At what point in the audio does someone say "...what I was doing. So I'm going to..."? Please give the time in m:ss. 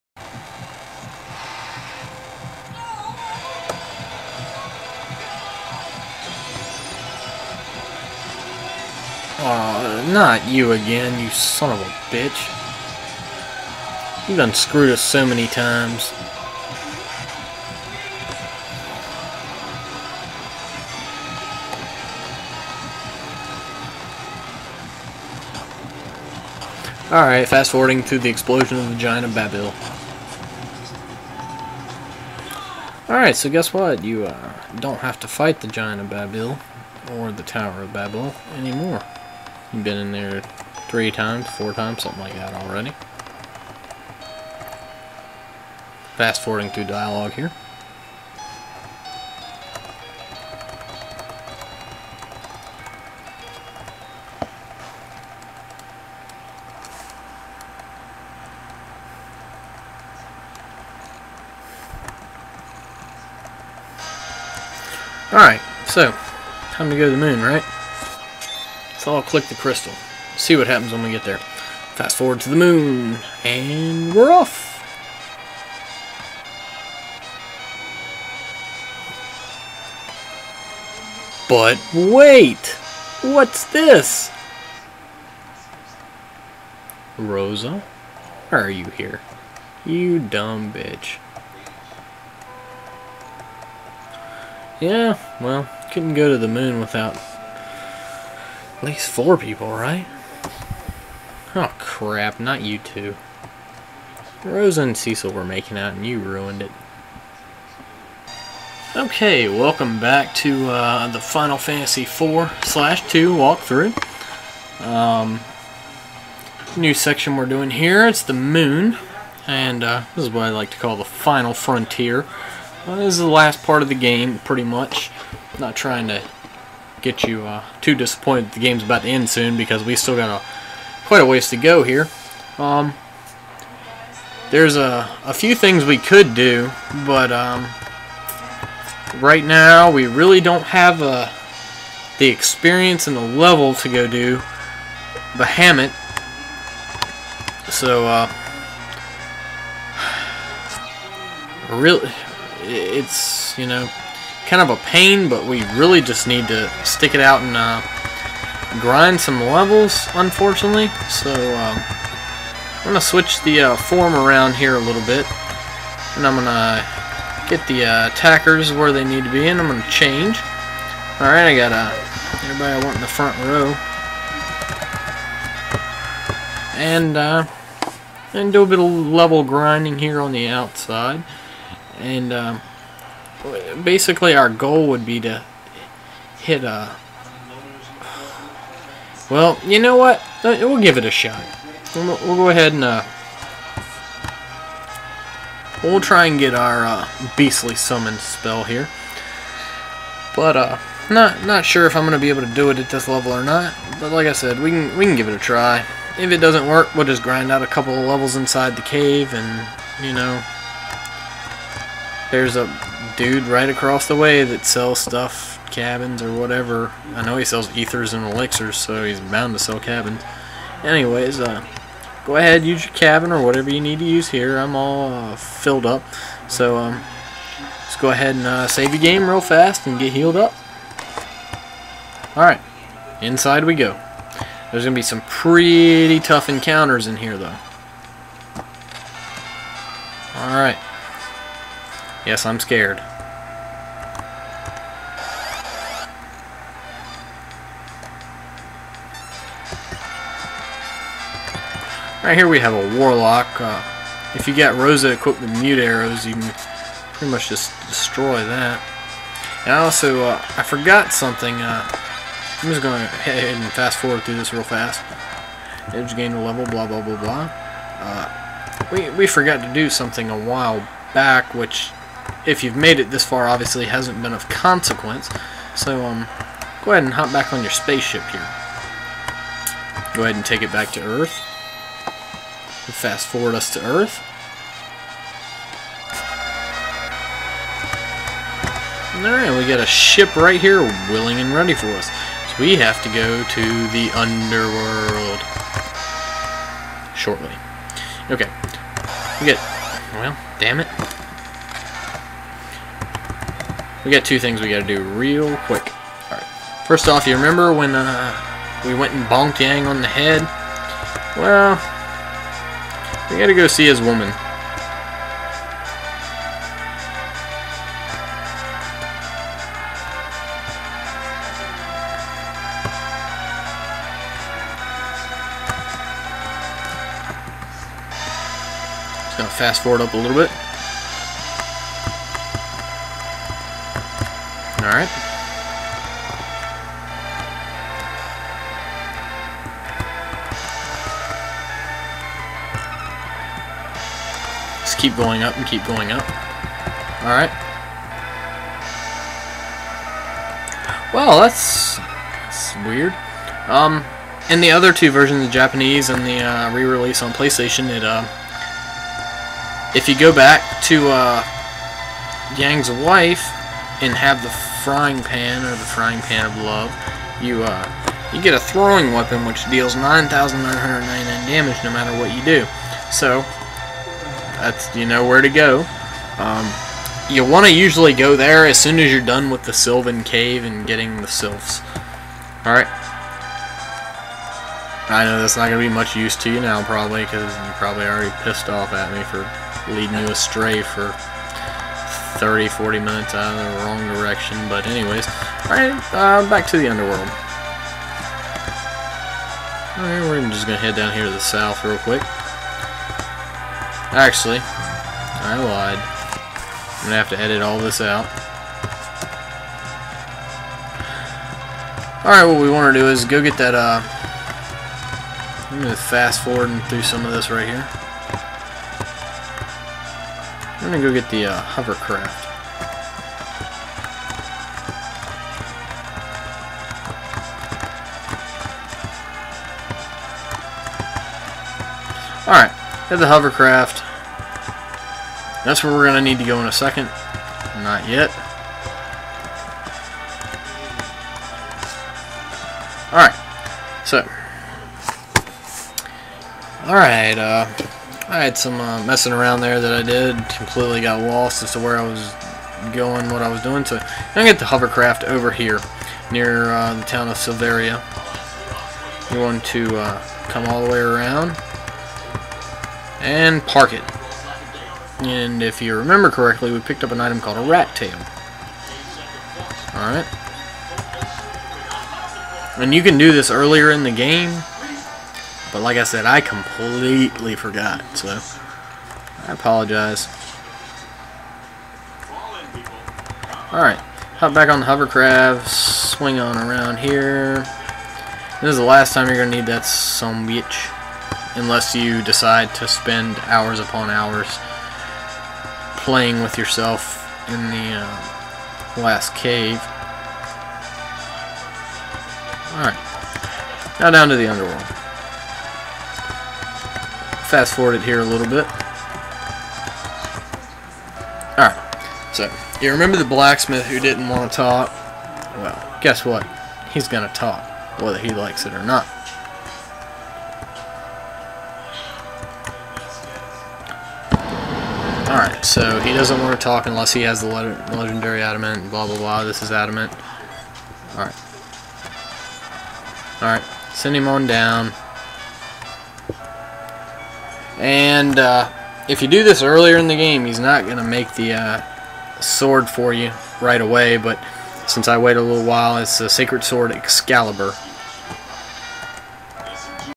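7:33.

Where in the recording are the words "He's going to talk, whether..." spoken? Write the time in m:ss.
8:36.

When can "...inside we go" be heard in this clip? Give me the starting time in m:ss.
3:53.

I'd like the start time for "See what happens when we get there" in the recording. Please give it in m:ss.
1:10.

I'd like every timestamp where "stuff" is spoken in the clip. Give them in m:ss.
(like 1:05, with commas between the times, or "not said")
3:34.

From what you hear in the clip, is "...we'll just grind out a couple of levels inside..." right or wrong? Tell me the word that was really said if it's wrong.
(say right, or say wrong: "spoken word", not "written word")
right.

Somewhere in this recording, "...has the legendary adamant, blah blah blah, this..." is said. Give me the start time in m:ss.
8:47.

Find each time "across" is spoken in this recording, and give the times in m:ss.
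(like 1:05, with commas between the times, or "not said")
3:33.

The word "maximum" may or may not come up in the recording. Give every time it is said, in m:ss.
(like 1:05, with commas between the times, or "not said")
not said.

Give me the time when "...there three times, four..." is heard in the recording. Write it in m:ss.
0:40.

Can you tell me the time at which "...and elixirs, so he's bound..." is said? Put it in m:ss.
3:38.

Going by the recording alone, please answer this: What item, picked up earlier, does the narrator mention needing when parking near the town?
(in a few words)
rat tail.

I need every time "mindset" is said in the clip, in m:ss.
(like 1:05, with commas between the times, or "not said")
not said.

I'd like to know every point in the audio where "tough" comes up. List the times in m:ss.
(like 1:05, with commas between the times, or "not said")
3:56.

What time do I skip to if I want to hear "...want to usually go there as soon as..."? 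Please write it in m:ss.
6:17.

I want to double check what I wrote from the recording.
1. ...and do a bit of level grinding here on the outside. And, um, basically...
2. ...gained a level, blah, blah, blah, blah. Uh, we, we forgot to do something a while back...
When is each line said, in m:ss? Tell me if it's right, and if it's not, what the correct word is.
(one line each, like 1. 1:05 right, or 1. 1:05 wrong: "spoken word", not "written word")
1. 2:58 right
2. 4:26 right.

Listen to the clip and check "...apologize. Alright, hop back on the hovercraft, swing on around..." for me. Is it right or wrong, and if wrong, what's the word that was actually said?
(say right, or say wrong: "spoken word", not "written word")
right.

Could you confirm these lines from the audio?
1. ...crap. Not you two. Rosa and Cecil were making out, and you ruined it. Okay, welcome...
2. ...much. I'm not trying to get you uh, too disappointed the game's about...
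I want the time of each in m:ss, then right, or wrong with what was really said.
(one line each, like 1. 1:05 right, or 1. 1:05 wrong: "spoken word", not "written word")
1. 1:41 right
2. 2:04 right.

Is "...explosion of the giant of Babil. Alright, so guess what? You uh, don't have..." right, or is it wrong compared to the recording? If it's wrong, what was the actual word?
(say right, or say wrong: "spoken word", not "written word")
right.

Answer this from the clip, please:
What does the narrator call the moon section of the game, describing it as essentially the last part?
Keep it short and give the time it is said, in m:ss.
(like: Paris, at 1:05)
the final frontier, at 2:00.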